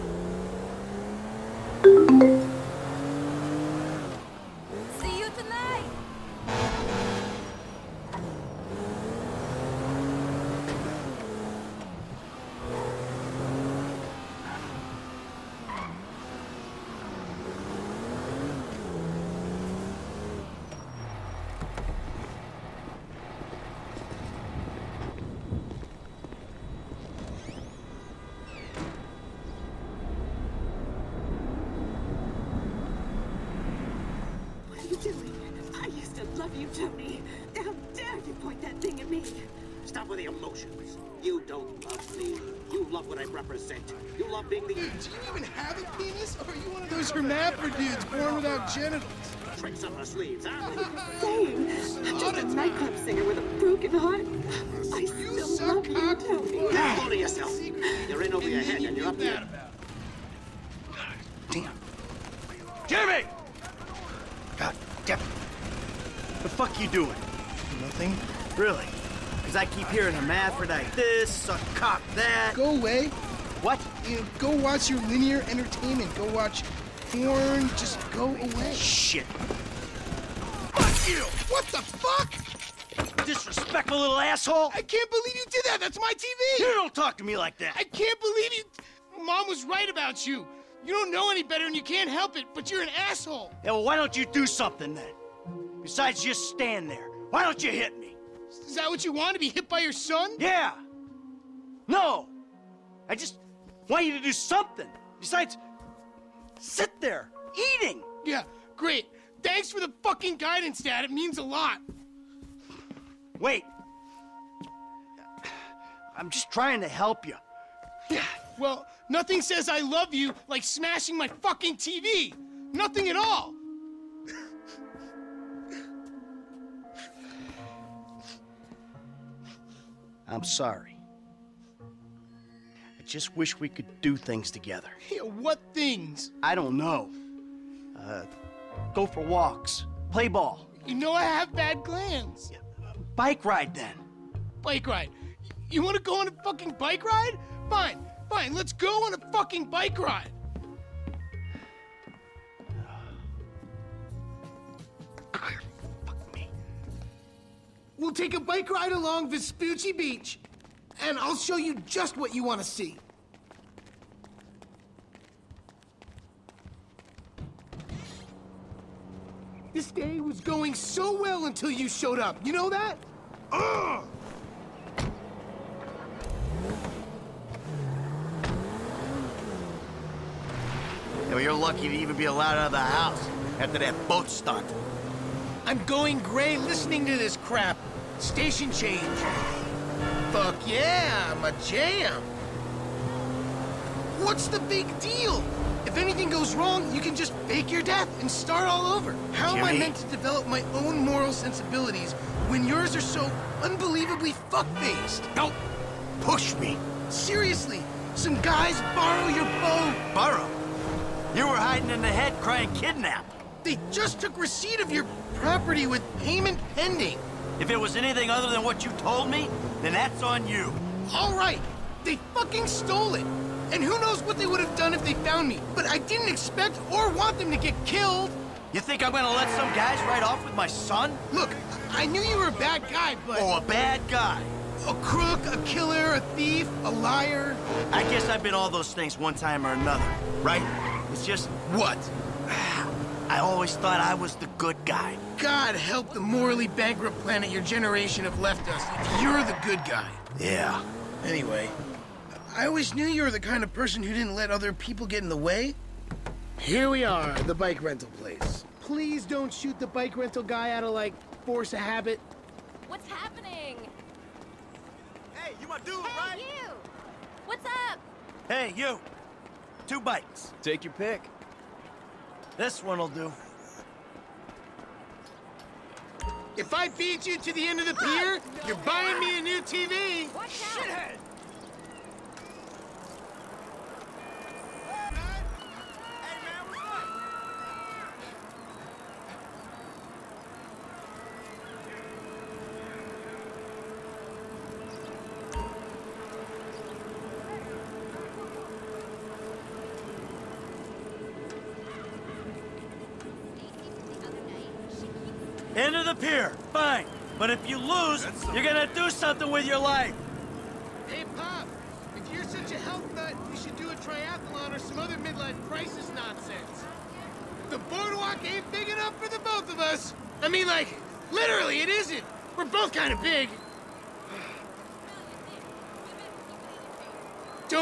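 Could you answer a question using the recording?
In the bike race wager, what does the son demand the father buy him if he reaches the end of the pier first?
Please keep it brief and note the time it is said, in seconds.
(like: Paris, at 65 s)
A new TV, at 279 s.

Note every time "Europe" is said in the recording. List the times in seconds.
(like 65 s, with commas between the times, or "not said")
not said.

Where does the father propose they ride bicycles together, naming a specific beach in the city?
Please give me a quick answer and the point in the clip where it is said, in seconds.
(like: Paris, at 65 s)
Vespucci Beach, at 159 s.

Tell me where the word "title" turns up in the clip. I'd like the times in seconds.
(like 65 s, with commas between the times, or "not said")
not said.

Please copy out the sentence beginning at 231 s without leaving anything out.
Look, I knew you were a bad guy, but...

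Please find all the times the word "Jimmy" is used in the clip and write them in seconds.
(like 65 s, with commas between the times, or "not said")
62 s, 199 s.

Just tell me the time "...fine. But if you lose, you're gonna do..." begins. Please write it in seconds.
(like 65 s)
306 s.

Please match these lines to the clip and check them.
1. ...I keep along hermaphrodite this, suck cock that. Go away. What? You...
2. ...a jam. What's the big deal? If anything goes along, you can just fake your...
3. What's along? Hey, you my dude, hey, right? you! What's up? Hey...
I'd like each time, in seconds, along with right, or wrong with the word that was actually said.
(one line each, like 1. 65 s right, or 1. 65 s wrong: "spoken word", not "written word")
1. 69 s wrong: "hearing", not "along"
2. 191 s wrong: "wrong", not "along"
3. 262 s wrong: "happening", not "along".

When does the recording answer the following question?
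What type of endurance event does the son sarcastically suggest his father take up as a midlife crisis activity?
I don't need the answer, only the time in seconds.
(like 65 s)
313 s.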